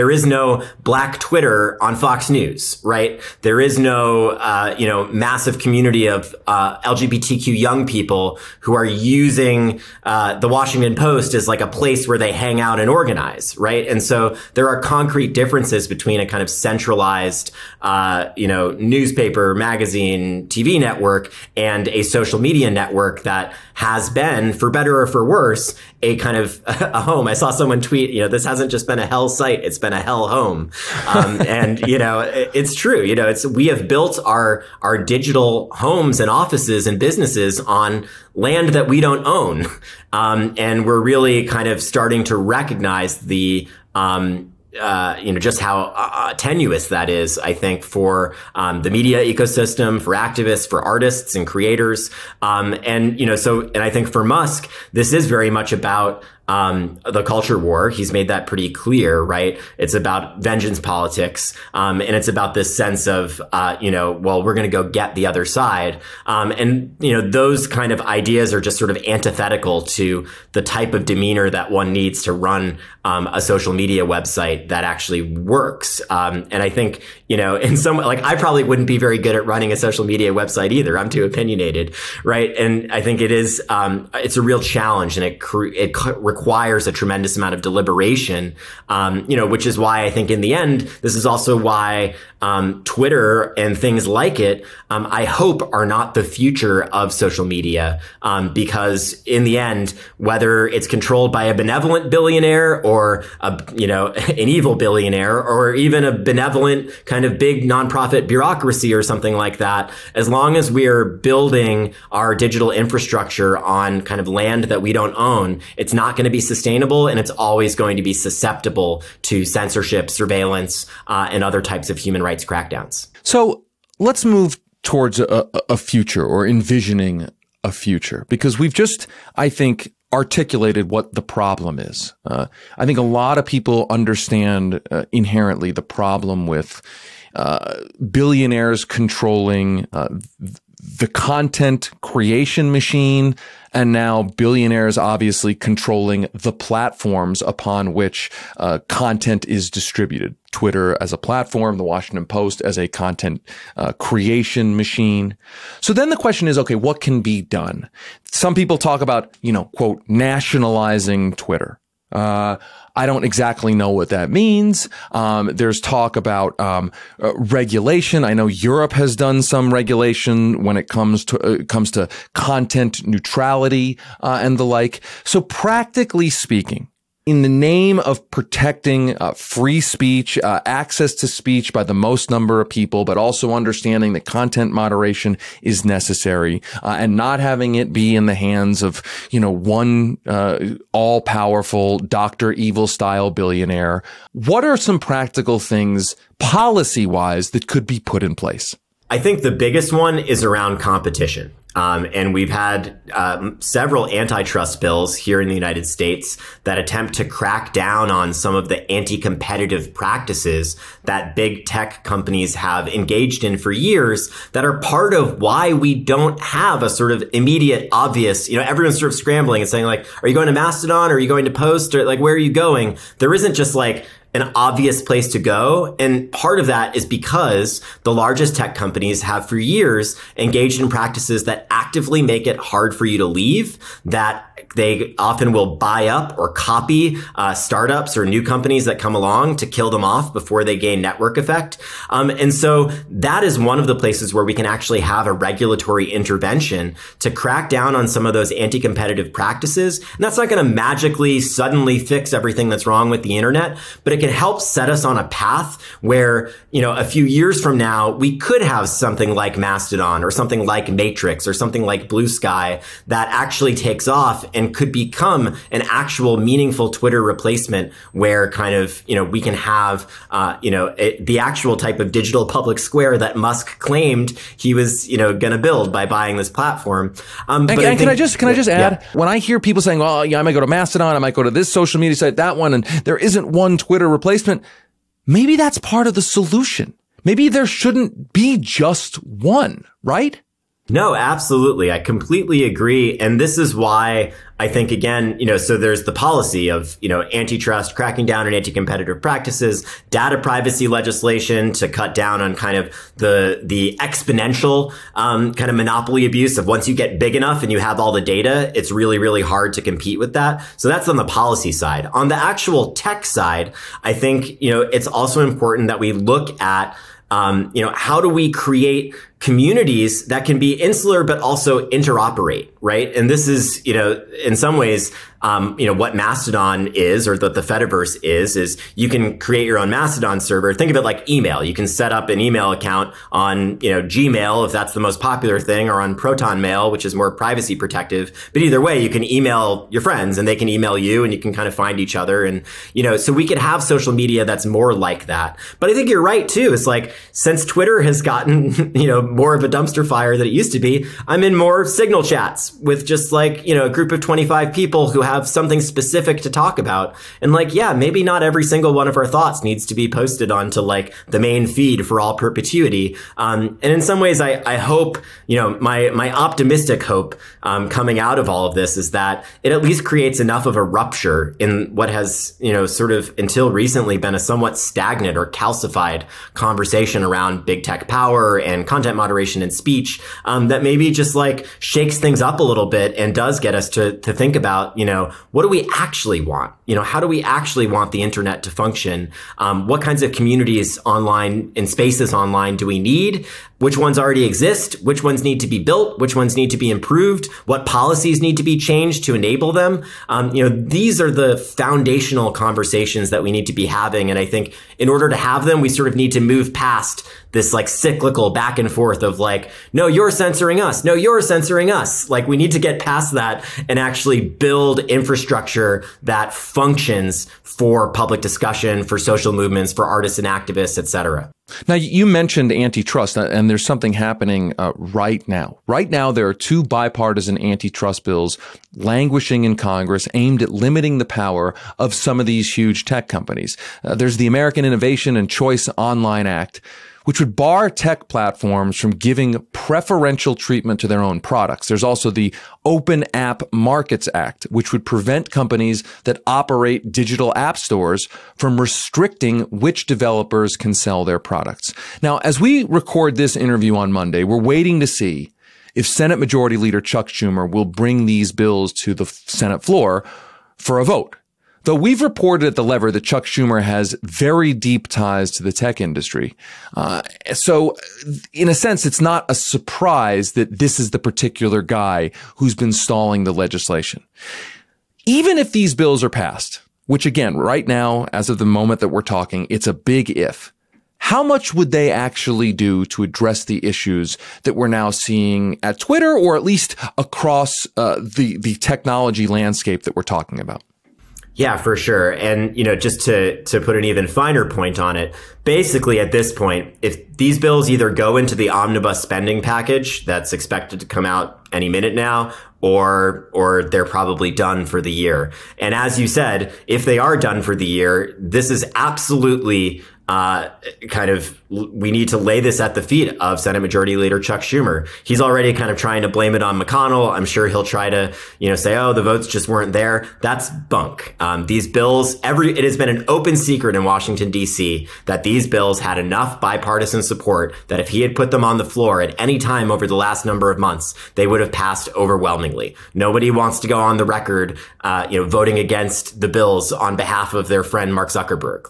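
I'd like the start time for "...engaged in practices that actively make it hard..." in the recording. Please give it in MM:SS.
03:50.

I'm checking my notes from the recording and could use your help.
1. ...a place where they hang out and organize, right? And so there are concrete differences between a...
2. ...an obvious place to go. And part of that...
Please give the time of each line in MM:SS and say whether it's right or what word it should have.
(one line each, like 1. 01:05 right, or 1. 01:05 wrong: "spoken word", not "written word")
1. 00:11 right
2. 03:44 right.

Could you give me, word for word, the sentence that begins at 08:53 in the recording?
Nobody wants to go on the record, uh, you know, voting against the bills on behalf of their friend Mark Zuckerberg.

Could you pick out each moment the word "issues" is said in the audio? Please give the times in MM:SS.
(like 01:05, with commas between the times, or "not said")
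08:03.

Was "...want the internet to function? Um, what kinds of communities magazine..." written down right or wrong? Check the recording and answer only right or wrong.
wrong.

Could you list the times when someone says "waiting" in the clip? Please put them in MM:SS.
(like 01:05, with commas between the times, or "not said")
07:34.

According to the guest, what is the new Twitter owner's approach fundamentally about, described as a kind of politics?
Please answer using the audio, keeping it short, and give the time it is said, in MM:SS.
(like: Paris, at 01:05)
vengeance politics, at 01:00.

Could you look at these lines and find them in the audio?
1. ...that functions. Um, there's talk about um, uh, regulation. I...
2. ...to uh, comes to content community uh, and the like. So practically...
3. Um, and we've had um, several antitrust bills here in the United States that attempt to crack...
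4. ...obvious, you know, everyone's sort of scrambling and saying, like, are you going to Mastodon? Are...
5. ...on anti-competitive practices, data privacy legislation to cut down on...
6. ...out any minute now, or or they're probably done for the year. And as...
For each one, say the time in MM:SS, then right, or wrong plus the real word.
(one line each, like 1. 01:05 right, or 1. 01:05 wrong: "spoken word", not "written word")
1. 02:44 wrong: "means", not "functions"
2. 02:51 wrong: "neutrality", not "community"
3. 03:21 right
4. 03:37 right
5. 04:58 right
6. 08:21 right.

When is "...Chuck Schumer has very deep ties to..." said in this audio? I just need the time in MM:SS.
07:43.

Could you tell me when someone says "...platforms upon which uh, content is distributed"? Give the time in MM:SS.
02:26.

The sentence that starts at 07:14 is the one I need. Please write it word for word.
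Uh, there's the American Innovation and Choice Online Act which would bar tech platforms from giving preferential treatment to their own products.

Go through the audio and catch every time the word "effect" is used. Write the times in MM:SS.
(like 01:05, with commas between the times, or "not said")
04:01.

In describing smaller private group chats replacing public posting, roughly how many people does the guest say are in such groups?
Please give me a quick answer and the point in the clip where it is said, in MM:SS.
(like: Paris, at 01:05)
25, at 05:54.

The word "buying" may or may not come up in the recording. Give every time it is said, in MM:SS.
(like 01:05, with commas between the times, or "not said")
04:36.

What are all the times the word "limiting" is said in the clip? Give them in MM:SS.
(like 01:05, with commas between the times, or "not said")
07:10.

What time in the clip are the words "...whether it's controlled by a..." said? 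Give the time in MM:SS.
01:40.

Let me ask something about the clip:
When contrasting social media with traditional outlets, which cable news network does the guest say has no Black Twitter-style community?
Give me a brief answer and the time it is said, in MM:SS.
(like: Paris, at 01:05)
Fox News, at 00:01.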